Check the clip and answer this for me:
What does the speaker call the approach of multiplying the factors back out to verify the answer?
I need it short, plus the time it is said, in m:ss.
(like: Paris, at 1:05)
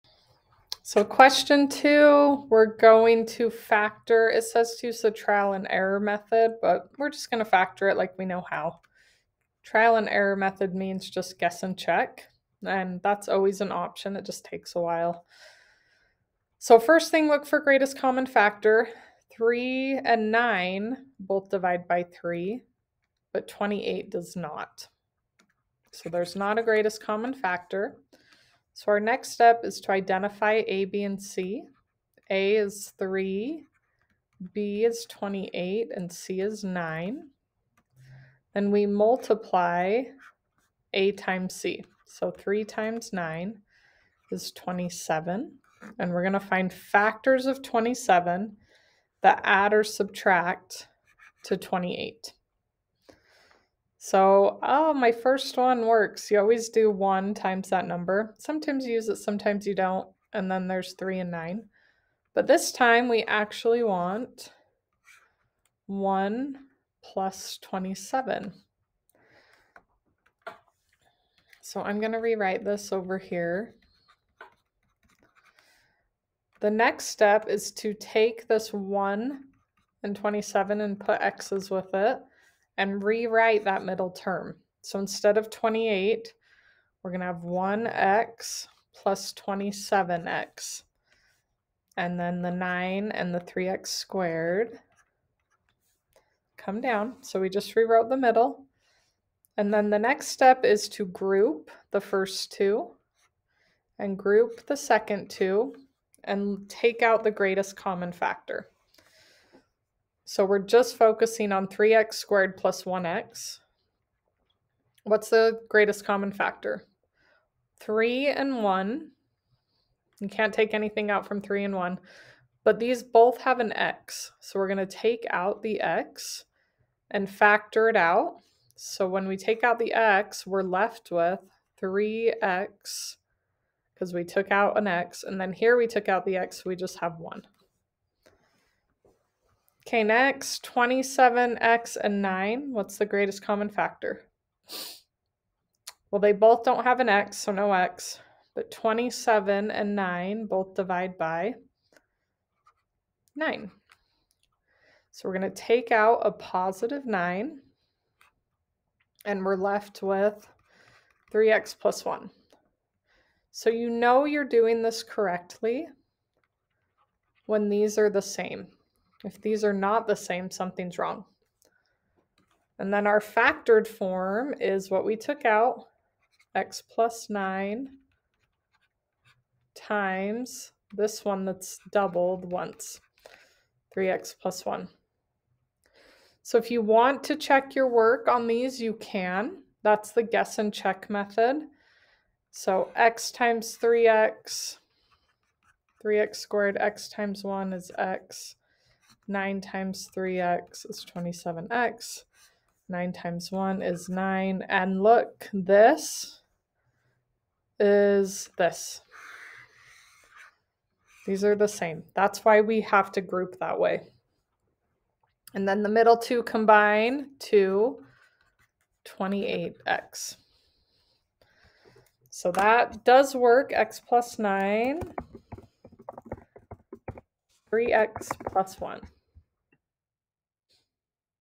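guess and check method, at 3:10.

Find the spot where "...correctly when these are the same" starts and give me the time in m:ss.
2:45.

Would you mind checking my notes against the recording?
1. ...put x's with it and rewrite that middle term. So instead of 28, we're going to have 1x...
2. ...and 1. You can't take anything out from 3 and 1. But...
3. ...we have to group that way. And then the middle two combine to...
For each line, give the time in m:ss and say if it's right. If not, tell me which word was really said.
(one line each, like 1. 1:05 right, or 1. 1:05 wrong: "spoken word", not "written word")
1. 1:20 right
2. 1:58 right
3. 3:32 right.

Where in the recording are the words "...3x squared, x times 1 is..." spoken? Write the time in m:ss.
3:16.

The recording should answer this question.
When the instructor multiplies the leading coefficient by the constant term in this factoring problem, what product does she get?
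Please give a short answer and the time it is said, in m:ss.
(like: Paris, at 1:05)
27, at 0:42.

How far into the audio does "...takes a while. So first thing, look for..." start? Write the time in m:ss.
0:14.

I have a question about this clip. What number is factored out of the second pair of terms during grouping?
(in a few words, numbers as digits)
9.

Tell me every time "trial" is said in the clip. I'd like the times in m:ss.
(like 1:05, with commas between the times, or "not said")
0:05, 0:09.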